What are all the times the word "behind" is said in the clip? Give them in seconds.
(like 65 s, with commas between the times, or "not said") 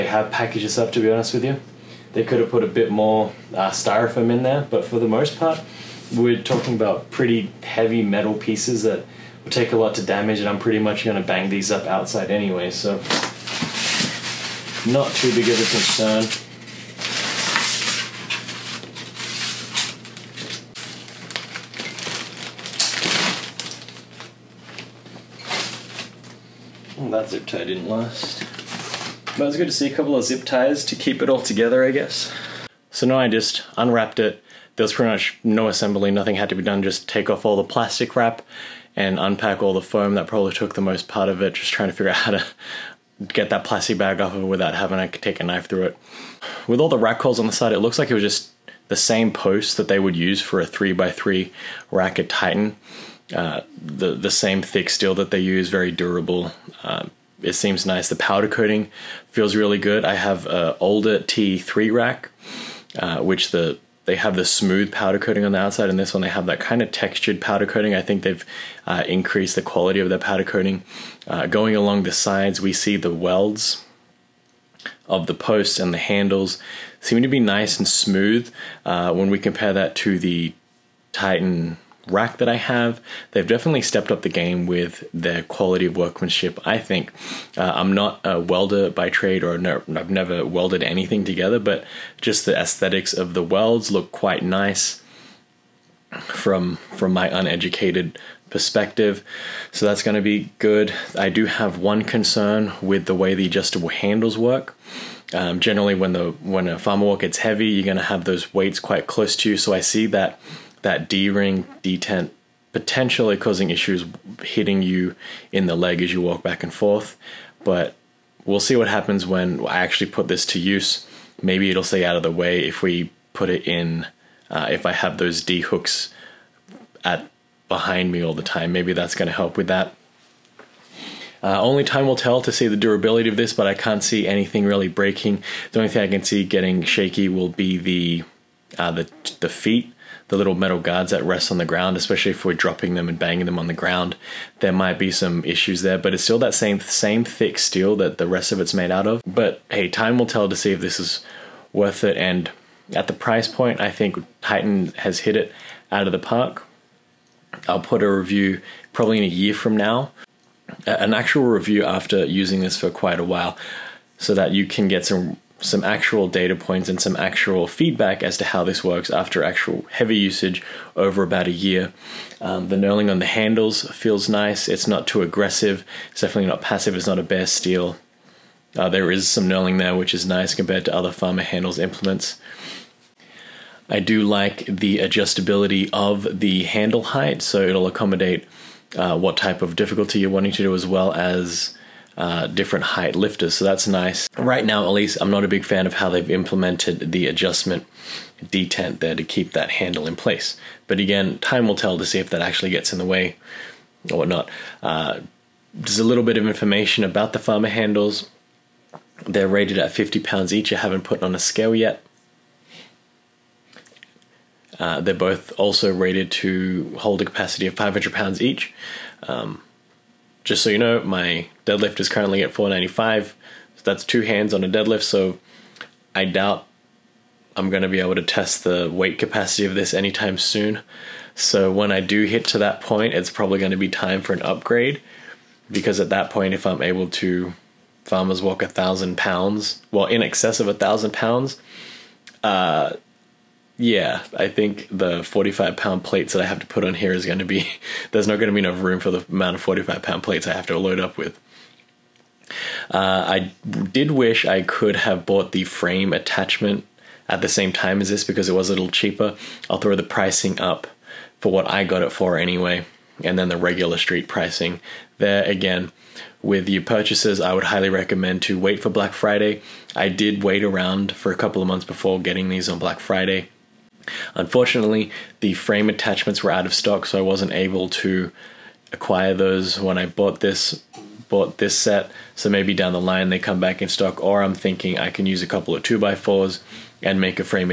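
127 s.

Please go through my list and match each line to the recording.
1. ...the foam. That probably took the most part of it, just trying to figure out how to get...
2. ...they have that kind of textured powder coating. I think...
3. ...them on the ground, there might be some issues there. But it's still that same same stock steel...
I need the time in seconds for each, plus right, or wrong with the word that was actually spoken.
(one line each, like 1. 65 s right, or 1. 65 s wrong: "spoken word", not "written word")
1. 39 s right
2. 66 s right
3. 143 s wrong: "thick", not "stock".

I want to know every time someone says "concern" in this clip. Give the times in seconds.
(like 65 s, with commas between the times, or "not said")
15 s, 102 s.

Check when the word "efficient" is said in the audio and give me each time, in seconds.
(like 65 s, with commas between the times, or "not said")
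not said.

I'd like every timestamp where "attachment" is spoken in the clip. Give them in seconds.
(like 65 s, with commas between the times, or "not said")
256 s, 275 s.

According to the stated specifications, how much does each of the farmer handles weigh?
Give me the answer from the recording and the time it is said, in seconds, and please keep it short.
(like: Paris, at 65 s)
50 pounds, at 209 s.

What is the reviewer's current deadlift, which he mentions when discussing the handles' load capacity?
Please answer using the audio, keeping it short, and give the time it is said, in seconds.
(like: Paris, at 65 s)
495, at 222 s.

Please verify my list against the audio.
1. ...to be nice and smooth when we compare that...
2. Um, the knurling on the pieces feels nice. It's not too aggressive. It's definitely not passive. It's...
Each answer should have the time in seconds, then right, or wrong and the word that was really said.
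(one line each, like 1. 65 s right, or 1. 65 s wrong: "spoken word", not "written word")
1. 77 s right
2. 172 s wrong: "handles", not "pieces".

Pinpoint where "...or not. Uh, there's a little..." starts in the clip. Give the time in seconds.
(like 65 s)
204 s.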